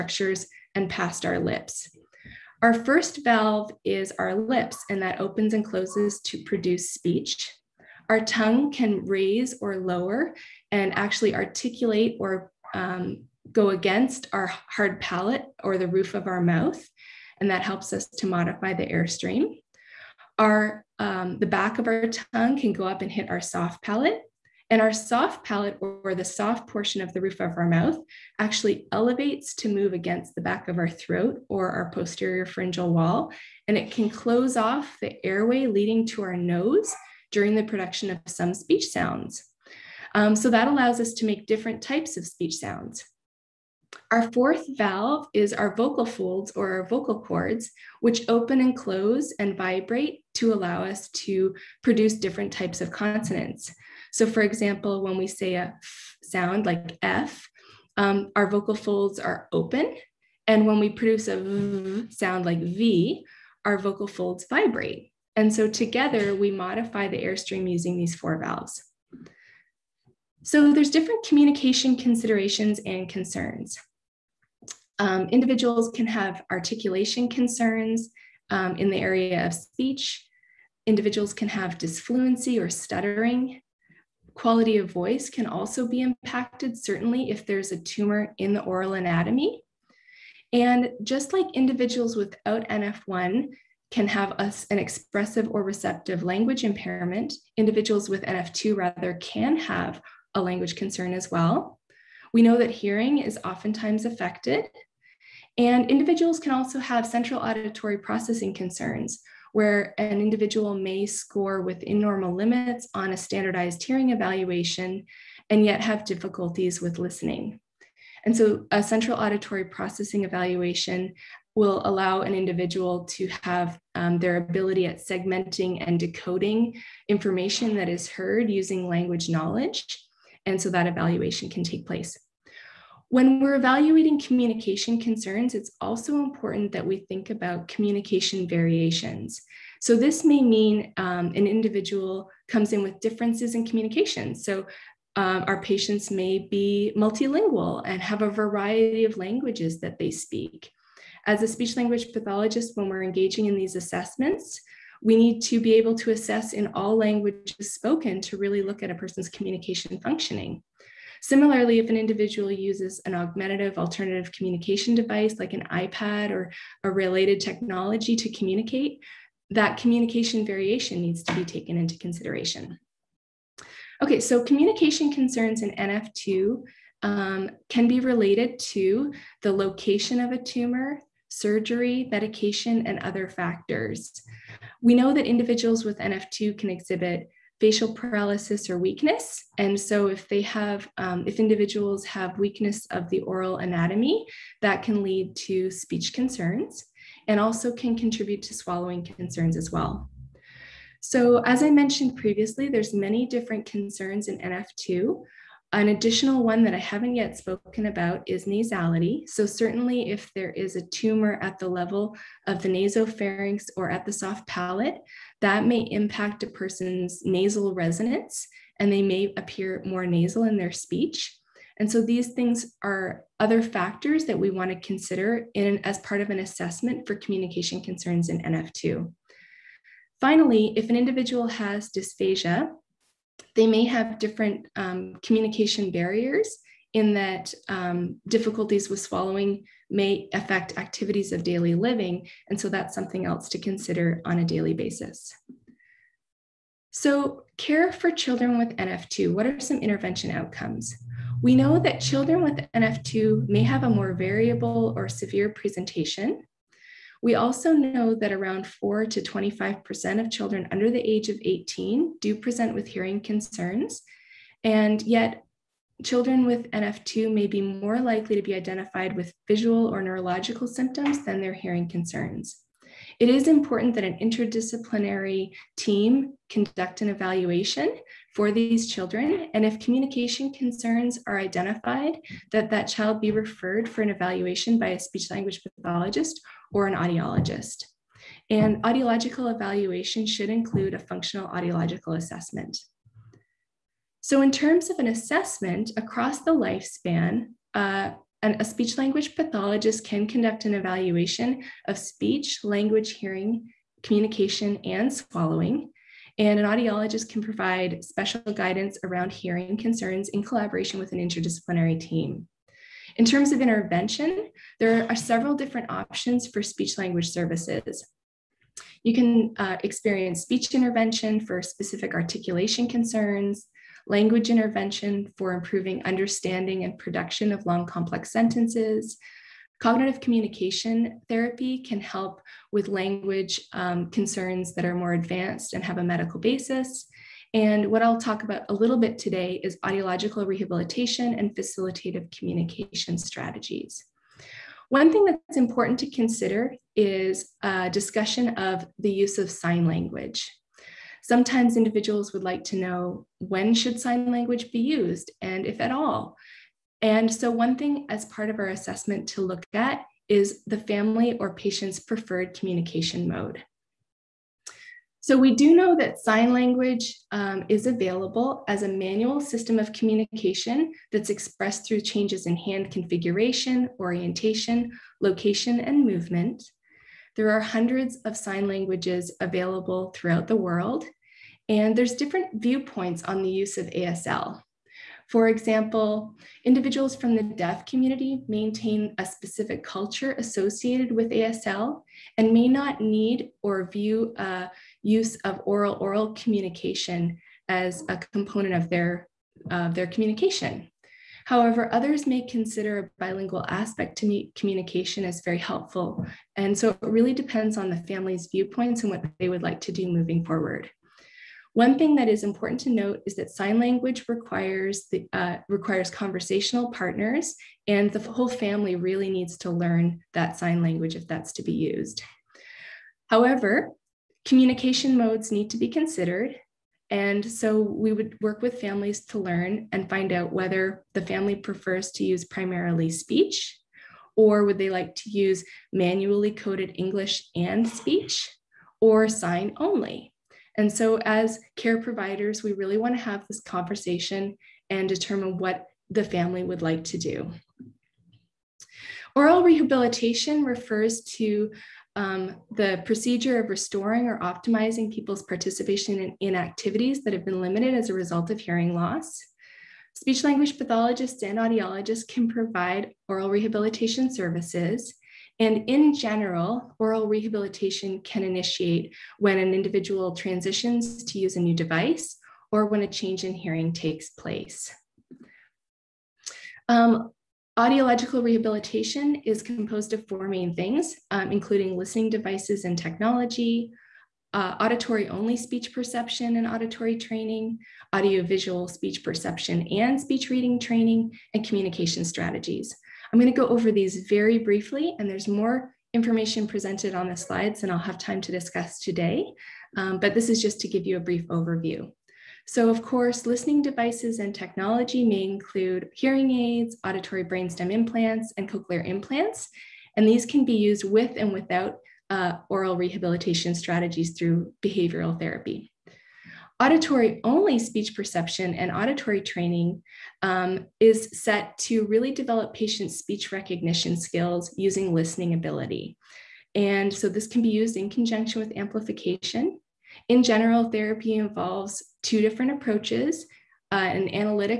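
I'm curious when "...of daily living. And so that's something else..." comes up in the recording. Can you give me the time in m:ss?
4:01.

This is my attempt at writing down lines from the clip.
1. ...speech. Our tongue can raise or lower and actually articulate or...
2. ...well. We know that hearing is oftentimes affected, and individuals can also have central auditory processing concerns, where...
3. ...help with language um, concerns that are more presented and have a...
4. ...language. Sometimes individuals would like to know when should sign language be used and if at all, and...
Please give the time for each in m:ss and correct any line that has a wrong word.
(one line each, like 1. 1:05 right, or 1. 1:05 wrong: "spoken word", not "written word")
1. 0:06 right
2. 1:41 right
3. 5:32 wrong: "advanced", not "presented"
4. 5:49 right.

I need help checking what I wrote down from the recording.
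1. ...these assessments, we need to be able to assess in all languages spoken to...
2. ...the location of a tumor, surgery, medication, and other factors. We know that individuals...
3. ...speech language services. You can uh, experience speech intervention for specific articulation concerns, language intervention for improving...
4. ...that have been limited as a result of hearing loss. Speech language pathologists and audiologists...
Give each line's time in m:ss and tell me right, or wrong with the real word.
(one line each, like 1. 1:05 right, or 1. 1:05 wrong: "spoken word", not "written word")
1. 2:33 right
2. 2:59 right
3. 5:16 right
4. 7:37 right.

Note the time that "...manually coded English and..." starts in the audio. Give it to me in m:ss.
7:15.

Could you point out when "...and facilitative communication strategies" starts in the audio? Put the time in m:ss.
5:41.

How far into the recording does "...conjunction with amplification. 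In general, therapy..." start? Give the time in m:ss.
8:48.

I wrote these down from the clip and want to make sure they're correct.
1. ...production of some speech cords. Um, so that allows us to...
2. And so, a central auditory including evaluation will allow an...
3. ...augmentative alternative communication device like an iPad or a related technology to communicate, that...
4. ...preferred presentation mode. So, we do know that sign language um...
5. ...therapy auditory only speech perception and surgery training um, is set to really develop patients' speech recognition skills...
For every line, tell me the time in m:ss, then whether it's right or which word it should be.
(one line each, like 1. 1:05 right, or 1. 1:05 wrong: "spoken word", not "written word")
1. 0:37 wrong: "sounds", not "cords"
2. 1:58 wrong: "processing", not "including"
3. 2:43 right
4. 6:01 wrong: "communication", not "presentation"
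5. 8:35 wrong: "auditory", not "surgery".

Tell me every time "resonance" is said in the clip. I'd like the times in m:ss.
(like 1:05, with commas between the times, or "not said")
3:37.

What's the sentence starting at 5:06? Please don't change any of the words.
And an audiologist can provide special guidance around hearing concerns in collaboration with an interdisciplinary team.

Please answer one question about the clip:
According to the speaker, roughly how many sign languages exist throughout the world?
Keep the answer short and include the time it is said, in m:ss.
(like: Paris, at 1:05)
Hundreds, at 6:17.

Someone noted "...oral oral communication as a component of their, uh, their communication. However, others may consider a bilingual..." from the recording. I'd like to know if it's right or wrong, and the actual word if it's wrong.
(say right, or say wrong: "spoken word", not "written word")
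right.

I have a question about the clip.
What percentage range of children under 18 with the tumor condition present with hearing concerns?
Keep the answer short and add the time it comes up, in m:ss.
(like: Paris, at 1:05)
4 to 25%, at 4:18.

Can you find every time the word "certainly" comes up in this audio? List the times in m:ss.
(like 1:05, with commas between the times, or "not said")
1:26, 3:29.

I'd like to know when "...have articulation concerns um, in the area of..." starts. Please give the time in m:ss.
1:16.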